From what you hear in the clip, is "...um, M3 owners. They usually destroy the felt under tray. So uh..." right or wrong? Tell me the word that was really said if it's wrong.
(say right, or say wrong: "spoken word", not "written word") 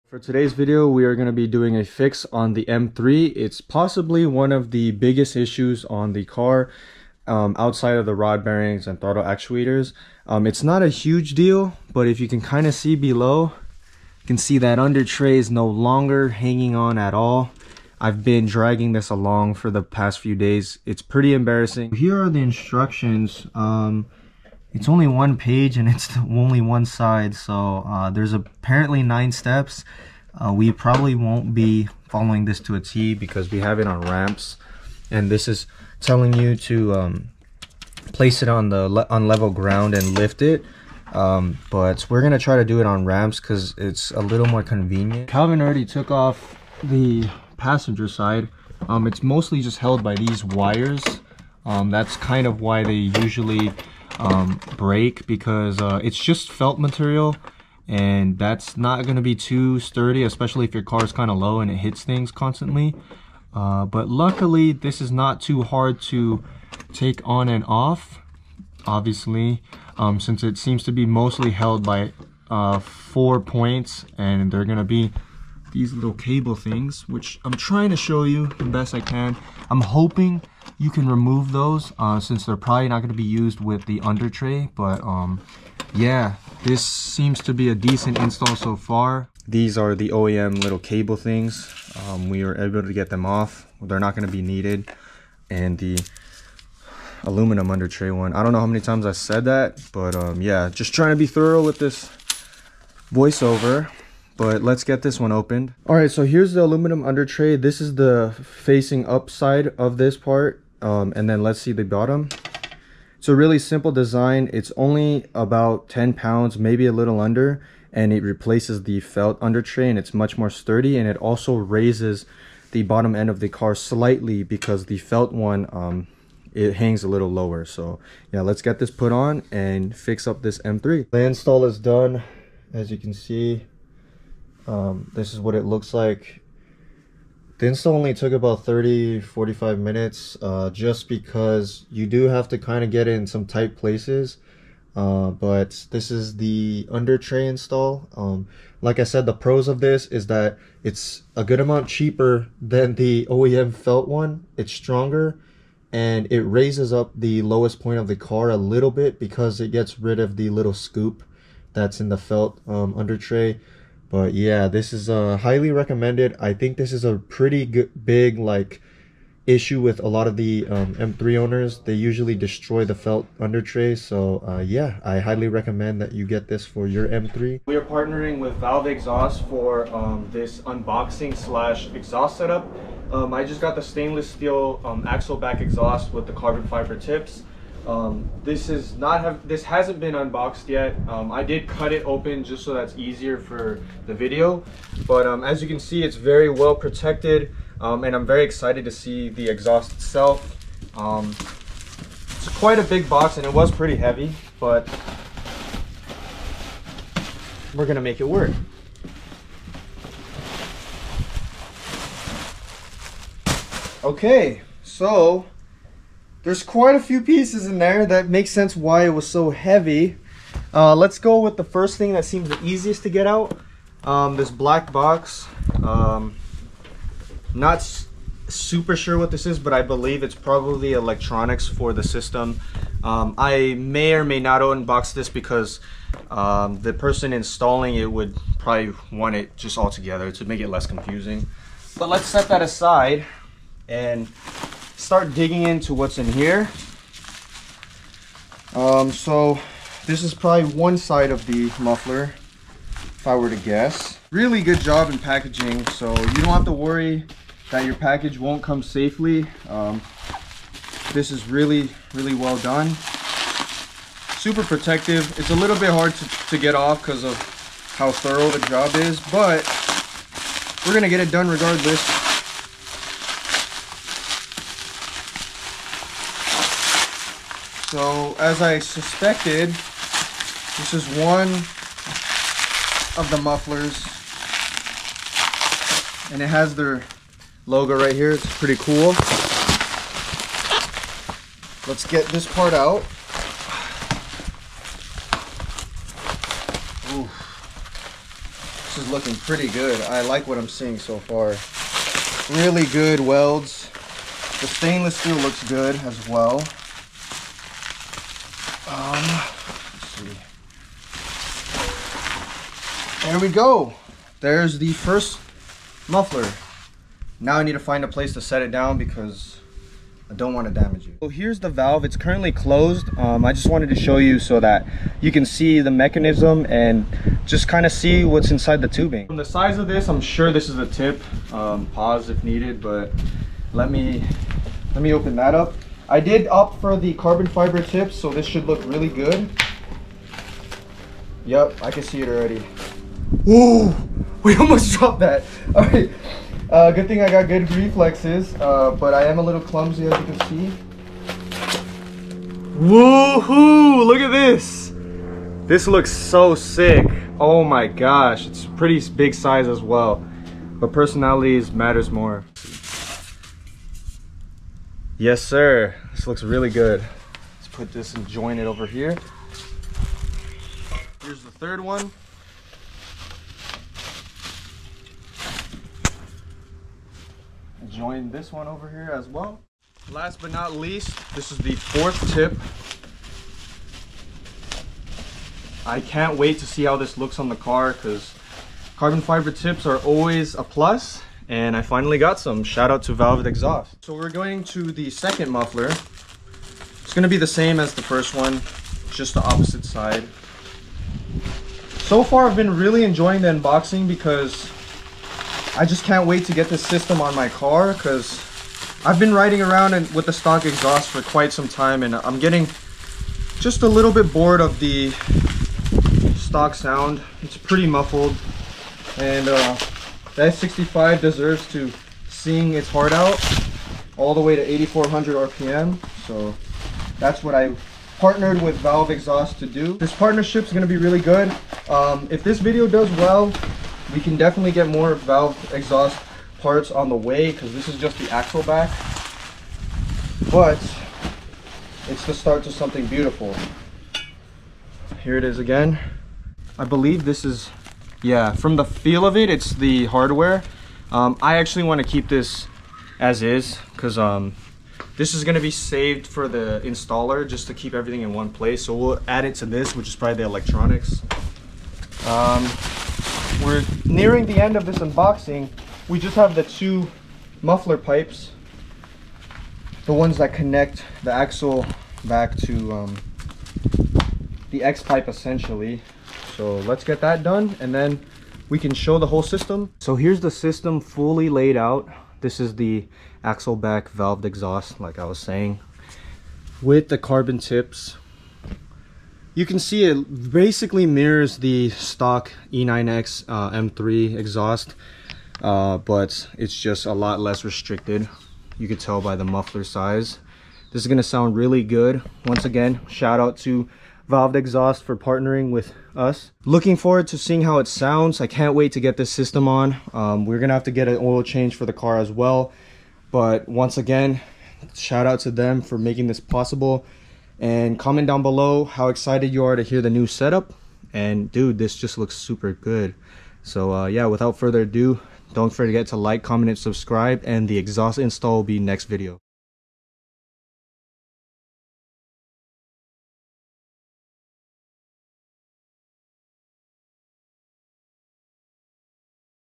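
right.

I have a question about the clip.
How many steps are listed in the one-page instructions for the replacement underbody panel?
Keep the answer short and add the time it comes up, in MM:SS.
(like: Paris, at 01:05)
9, at 00:29.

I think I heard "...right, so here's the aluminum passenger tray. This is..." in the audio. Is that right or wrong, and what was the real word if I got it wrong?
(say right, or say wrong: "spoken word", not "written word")
wrong: "under", not "passenger".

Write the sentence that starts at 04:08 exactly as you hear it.
Um, so this is probably one side of the muffler, if I were to guess.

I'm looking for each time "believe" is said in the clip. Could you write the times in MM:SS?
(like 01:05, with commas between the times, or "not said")
03:49, 07:26.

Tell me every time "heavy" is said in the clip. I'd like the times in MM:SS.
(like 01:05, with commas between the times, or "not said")
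03:23, 03:39.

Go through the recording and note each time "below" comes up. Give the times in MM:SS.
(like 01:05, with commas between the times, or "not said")
00:12, 08:38.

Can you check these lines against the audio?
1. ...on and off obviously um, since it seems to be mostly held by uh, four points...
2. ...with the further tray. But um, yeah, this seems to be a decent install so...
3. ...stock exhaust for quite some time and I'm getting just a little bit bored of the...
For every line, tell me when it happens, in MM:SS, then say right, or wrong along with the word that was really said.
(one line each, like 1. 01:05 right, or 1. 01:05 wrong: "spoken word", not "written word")
1. 01:07 right
2. 01:23 wrong: "under", not "further"
3. 06:50 right.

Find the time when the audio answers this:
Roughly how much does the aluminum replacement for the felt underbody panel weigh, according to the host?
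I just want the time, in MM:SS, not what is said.
01:55.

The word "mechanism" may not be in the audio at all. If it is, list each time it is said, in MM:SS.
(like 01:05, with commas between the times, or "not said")
05:25.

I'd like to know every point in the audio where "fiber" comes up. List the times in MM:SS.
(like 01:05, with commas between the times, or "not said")
03:06, 05:37, 06:29.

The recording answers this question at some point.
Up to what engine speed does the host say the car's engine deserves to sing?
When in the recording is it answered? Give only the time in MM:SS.
07:04.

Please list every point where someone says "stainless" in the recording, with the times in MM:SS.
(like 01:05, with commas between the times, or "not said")
03:03, 05:04.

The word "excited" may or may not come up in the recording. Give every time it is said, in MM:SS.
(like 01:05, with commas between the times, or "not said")
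03:18, 08:39.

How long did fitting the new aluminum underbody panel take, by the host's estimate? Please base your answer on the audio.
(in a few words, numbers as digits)
30 to 45 minutes.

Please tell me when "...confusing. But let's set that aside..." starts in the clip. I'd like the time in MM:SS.
04:00.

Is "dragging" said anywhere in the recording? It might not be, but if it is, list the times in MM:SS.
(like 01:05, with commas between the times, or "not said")
00:18.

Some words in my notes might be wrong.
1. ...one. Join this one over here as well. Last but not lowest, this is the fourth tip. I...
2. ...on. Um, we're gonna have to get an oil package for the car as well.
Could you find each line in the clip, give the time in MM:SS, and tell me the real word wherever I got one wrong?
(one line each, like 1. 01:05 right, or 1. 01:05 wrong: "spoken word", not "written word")
1. 06:11 wrong: "least", not "lowest"
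2. 08:29 wrong: "change", not "package".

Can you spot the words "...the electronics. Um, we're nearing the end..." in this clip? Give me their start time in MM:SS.
07:40.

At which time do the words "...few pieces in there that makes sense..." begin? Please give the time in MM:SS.
03:36.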